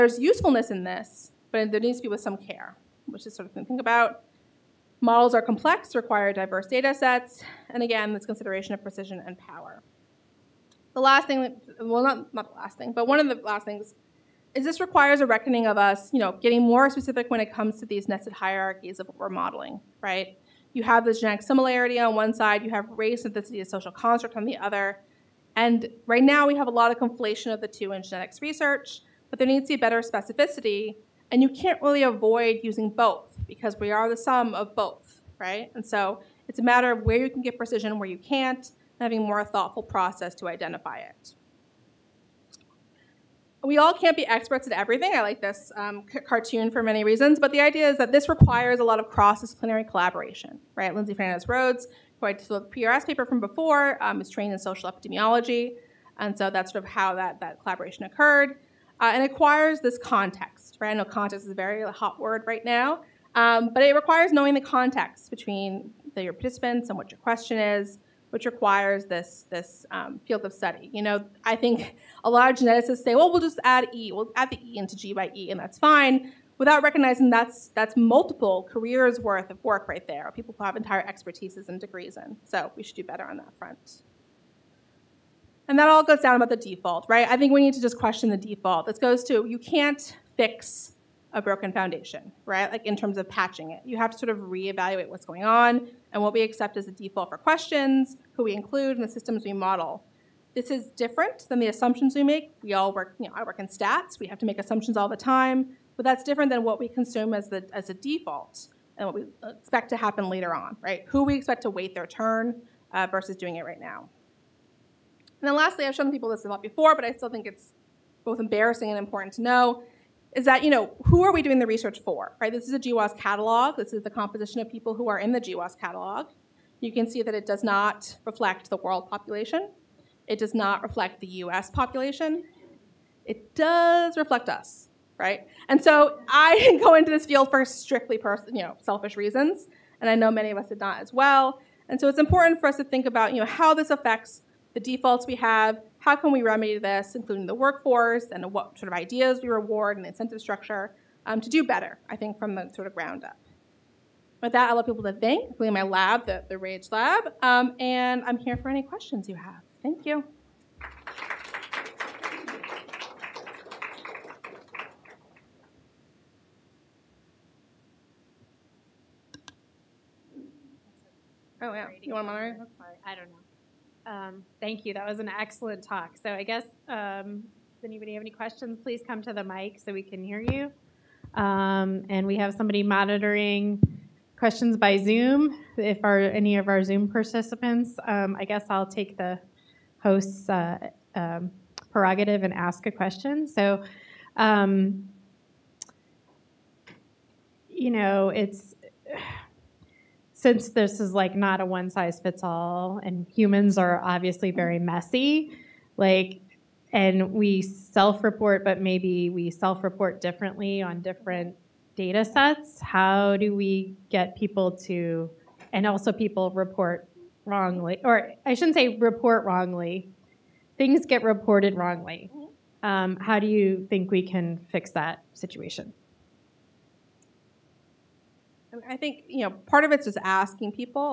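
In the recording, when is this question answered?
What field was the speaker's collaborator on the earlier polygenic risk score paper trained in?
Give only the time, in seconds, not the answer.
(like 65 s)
54 s.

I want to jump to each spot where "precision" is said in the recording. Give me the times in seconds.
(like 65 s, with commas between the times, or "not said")
8 s, 37 s.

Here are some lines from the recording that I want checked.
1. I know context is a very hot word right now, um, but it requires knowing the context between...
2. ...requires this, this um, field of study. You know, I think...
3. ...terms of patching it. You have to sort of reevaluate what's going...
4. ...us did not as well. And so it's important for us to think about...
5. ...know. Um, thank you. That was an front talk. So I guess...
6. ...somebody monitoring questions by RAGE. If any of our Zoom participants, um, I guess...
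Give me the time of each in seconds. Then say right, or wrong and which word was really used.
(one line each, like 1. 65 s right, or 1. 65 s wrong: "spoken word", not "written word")
1. 60 s right
2. 68 s right
3. 92 s right
4. 140 s right
5. 173 s wrong: "excellent", not "front"
6. 182 s wrong: "Zoom", not "RAGE".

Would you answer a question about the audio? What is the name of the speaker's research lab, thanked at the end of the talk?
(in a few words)
RAGE lab.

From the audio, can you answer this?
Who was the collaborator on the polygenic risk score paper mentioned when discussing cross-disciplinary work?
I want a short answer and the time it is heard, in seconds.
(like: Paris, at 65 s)
Lindsay Fernandez Rhodes, at 50 s.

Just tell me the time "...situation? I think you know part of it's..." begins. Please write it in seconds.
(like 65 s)
225 s.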